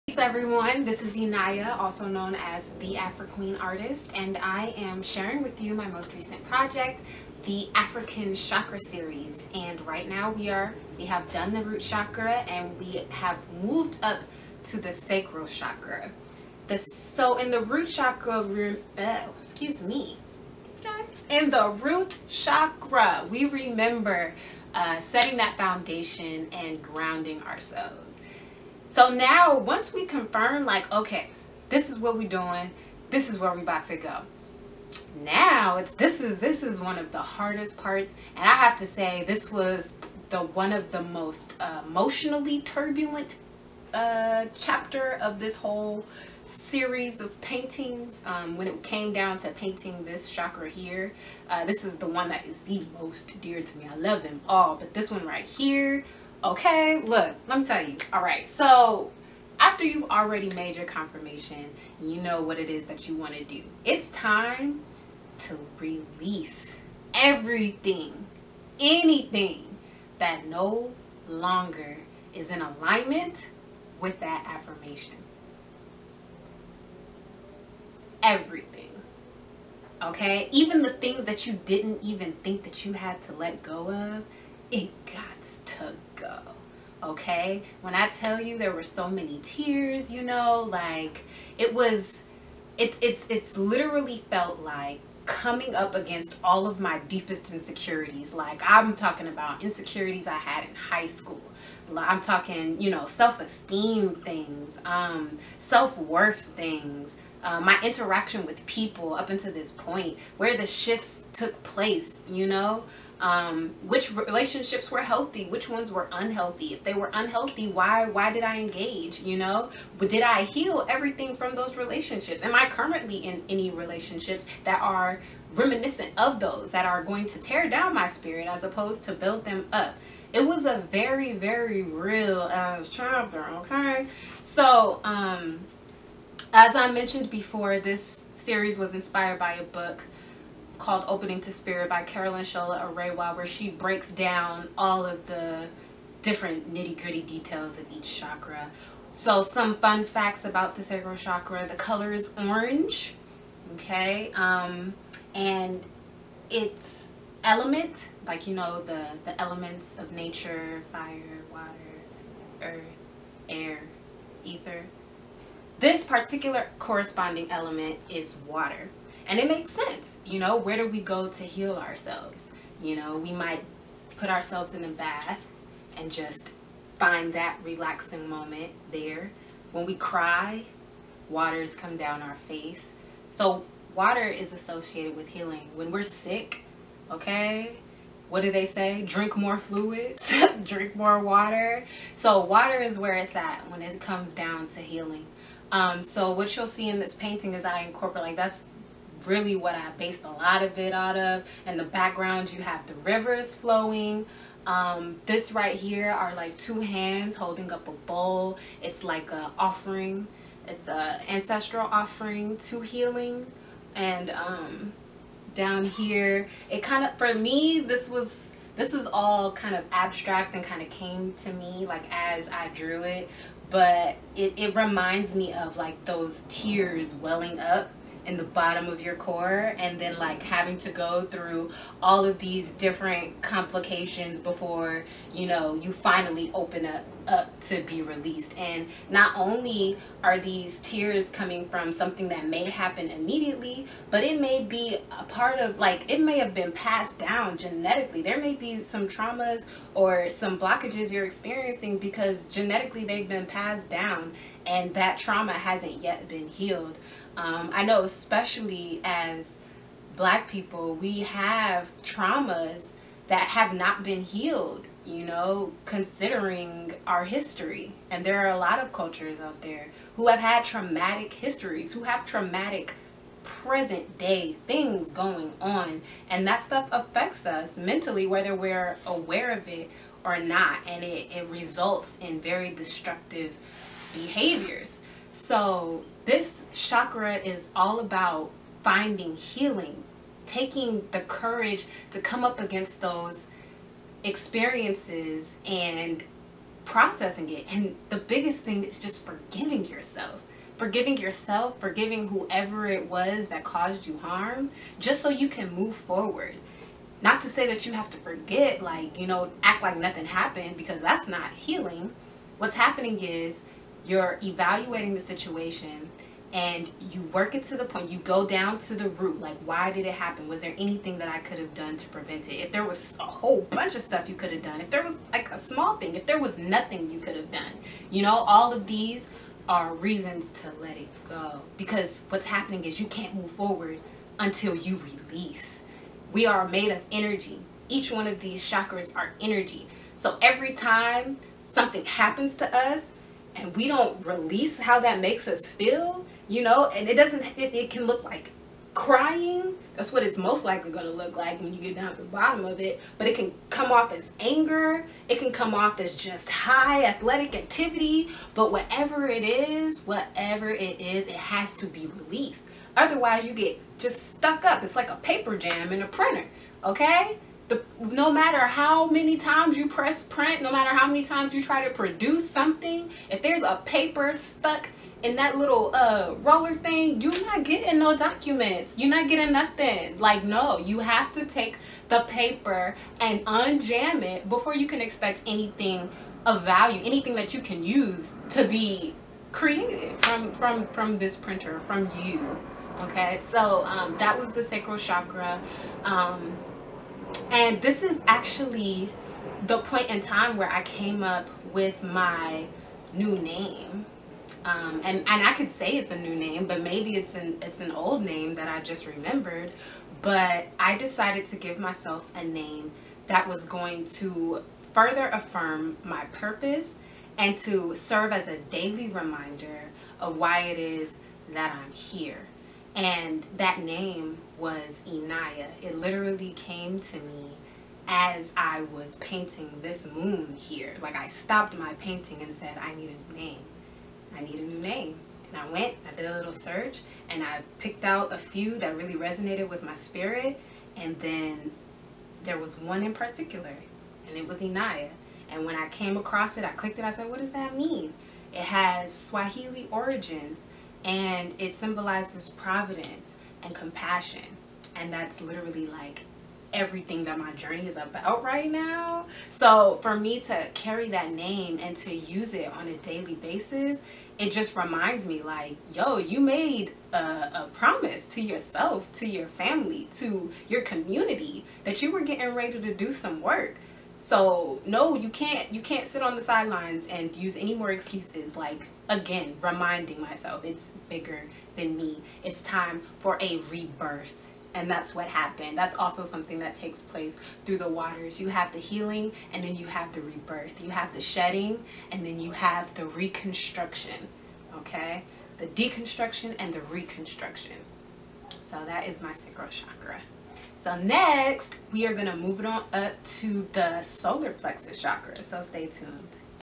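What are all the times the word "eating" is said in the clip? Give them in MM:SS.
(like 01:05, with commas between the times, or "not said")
not said.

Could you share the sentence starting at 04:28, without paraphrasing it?
And there are a lot of cultures out there who have had traumatic histories, who have traumatic present day things going on.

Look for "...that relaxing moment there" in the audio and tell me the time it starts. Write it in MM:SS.
02:57.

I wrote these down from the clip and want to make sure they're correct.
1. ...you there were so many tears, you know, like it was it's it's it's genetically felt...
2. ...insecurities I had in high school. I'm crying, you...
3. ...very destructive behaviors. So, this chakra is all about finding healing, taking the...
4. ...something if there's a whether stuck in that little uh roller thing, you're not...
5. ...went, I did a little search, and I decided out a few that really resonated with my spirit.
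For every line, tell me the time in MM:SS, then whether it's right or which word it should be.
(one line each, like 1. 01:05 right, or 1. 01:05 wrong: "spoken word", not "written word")
1. 01:28 wrong: "literally", not "genetically"
2. 01:39 wrong: "talking", not "crying"
3. 04:42 right
4. 06:12 wrong: "paper", not "whether"
5. 07:15 wrong: "picked", not "decided".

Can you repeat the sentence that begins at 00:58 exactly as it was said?
All right, so after you've already made your confirmation, you know what it is that you want to do.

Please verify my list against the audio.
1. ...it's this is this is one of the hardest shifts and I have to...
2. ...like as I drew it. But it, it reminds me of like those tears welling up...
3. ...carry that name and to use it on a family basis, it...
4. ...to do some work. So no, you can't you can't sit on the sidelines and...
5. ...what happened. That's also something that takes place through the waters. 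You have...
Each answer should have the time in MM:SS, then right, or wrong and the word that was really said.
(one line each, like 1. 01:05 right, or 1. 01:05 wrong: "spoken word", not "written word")
1. 00:35 wrong: "parts", not "shifts"
2. 03:41 right
3. 07:40 wrong: "daily", not "family"
4. 07:52 right
5. 08:05 right.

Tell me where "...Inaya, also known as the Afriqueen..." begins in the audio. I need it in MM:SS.
00:01.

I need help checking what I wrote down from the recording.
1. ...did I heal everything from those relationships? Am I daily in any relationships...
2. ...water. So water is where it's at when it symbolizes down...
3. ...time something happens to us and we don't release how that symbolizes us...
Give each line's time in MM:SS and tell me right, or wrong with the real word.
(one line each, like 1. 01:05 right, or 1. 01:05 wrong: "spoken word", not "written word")
1. 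01:59 wrong: "currently", not "daily"
2. 03:11 wrong: "comes", not "symbolizes"
3. 05:40 wrong: "makes", not "symbolizes".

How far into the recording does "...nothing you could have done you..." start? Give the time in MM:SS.
05:26.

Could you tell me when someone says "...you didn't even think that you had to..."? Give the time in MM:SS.
01:21.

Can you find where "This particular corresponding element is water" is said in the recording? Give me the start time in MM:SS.
02:45.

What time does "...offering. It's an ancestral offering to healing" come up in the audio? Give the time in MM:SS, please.
03:29.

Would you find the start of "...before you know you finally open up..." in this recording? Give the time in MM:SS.
03:54.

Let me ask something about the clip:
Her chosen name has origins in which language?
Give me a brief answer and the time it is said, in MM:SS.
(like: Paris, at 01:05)
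Swahili, at 07:29.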